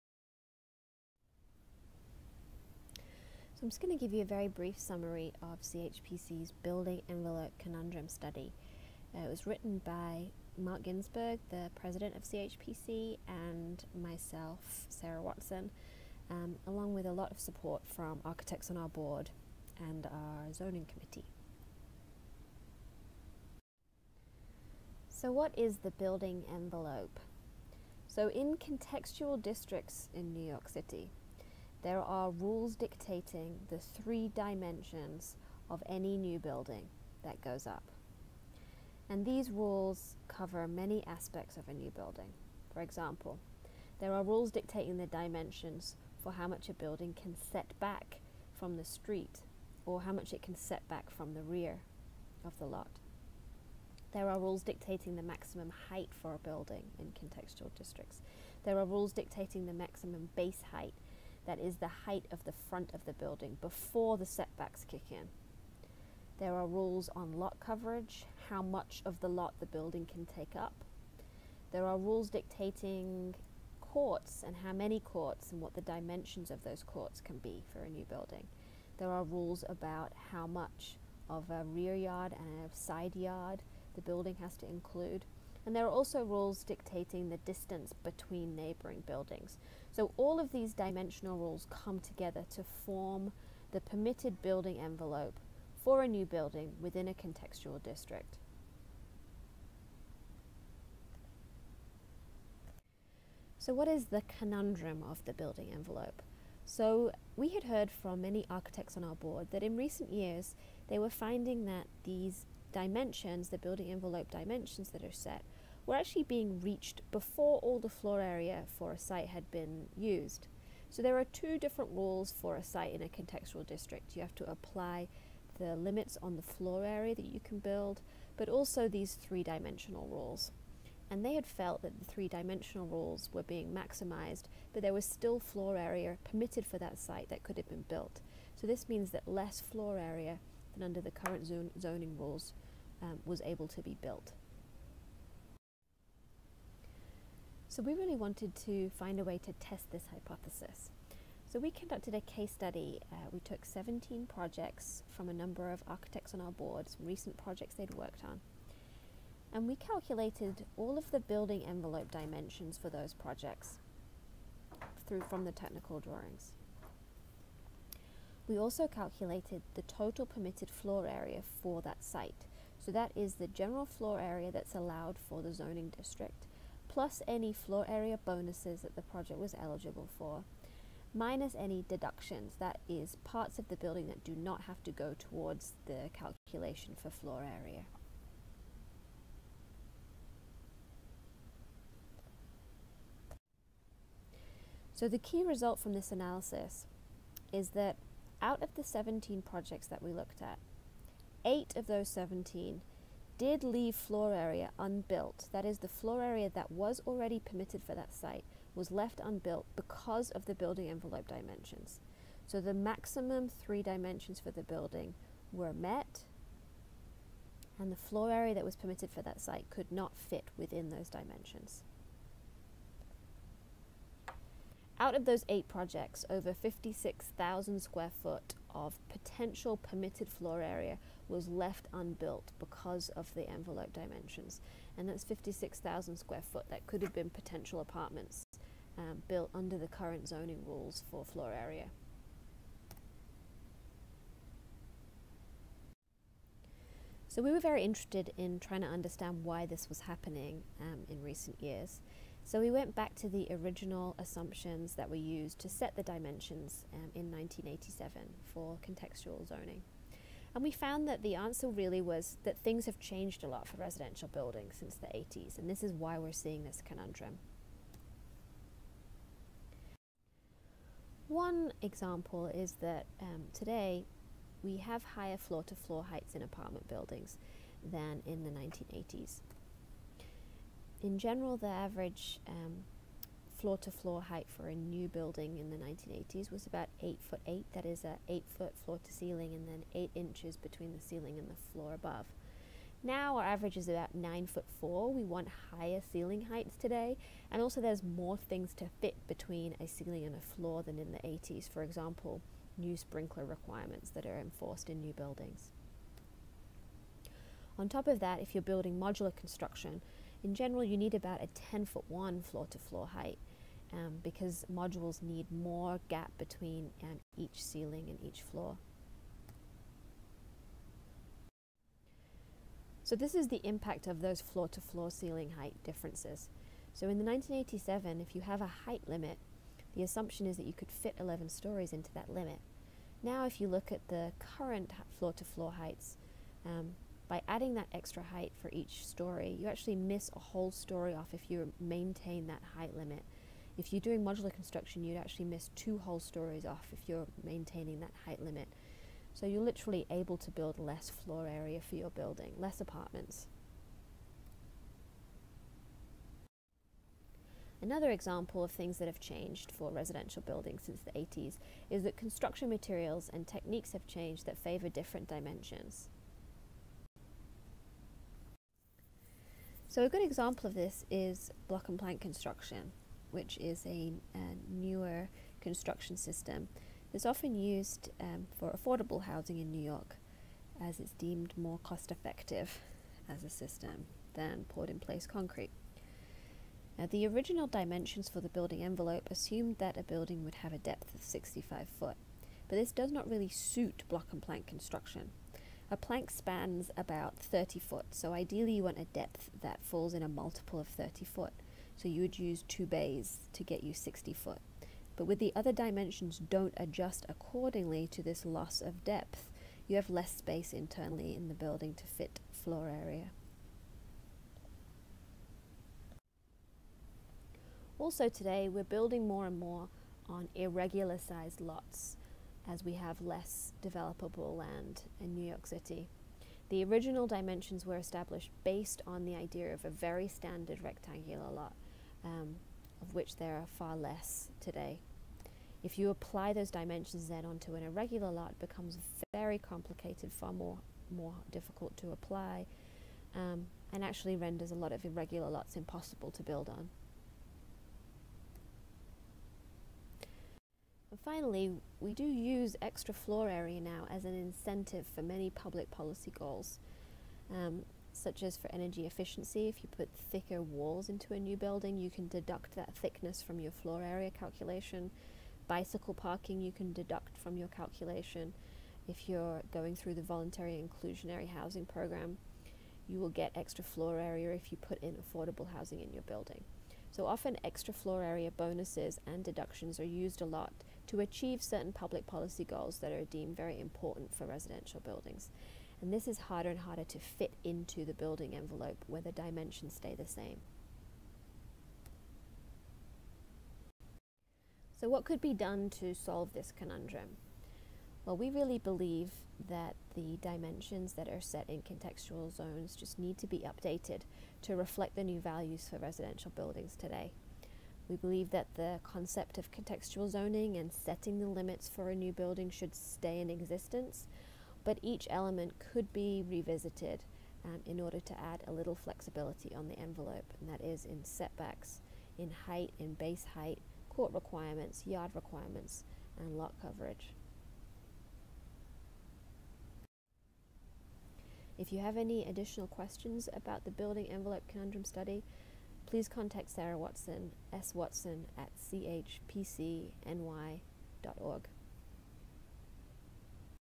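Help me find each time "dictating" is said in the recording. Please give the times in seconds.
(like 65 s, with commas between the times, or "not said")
32 s, 44 s, 54 s, 59 s, 72 s, 86 s.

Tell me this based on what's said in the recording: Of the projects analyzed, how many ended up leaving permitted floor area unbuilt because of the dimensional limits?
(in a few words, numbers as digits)
8.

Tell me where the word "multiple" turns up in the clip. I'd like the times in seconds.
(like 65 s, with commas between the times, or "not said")
400 s.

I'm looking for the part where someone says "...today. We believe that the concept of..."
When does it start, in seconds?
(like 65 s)
506 s.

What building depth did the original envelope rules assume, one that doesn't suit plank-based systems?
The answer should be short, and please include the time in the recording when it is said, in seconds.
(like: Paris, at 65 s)
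65 feet, at 391 s.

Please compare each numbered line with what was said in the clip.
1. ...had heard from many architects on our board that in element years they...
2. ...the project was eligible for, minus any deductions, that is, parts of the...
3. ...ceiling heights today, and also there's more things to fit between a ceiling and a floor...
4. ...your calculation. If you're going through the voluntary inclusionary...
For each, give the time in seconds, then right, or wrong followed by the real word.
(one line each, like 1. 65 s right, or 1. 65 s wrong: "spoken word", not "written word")
1. 107 s wrong: "recent", not "element"
2. 178 s right
3. 296 s right
4. 467 s right.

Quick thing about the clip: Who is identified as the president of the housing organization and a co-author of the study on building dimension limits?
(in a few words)
Mark Ginsberg.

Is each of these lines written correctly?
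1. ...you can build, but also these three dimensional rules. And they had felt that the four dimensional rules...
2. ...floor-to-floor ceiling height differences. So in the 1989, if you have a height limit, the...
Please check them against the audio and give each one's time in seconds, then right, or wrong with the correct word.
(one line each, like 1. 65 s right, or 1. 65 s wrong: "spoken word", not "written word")
1. 127 s wrong: "three", not "four"
2. 324 s wrong: "1987", not "1989".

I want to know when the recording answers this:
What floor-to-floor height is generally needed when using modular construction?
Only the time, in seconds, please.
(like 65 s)
311 s.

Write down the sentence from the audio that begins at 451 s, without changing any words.
finally, we do use extra floor area now as an incentive for many public policy goals.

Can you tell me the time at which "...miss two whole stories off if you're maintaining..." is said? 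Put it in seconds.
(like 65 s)
345 s.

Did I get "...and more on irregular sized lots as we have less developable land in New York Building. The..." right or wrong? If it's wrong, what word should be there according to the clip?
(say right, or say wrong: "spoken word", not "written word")
wrong: "City", not "Building".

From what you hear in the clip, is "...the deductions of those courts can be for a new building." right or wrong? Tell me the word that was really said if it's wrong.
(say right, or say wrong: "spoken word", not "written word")
wrong: "dimensions", not "deductions".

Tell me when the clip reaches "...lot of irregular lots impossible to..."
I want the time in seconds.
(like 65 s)
444 s.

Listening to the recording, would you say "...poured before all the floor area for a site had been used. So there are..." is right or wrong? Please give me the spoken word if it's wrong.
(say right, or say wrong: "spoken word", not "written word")
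wrong: "reached", not "poured".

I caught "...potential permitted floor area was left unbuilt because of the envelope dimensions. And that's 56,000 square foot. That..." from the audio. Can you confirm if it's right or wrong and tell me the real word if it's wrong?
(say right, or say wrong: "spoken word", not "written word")
right.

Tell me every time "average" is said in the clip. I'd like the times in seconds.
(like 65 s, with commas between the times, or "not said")
281 s, 293 s.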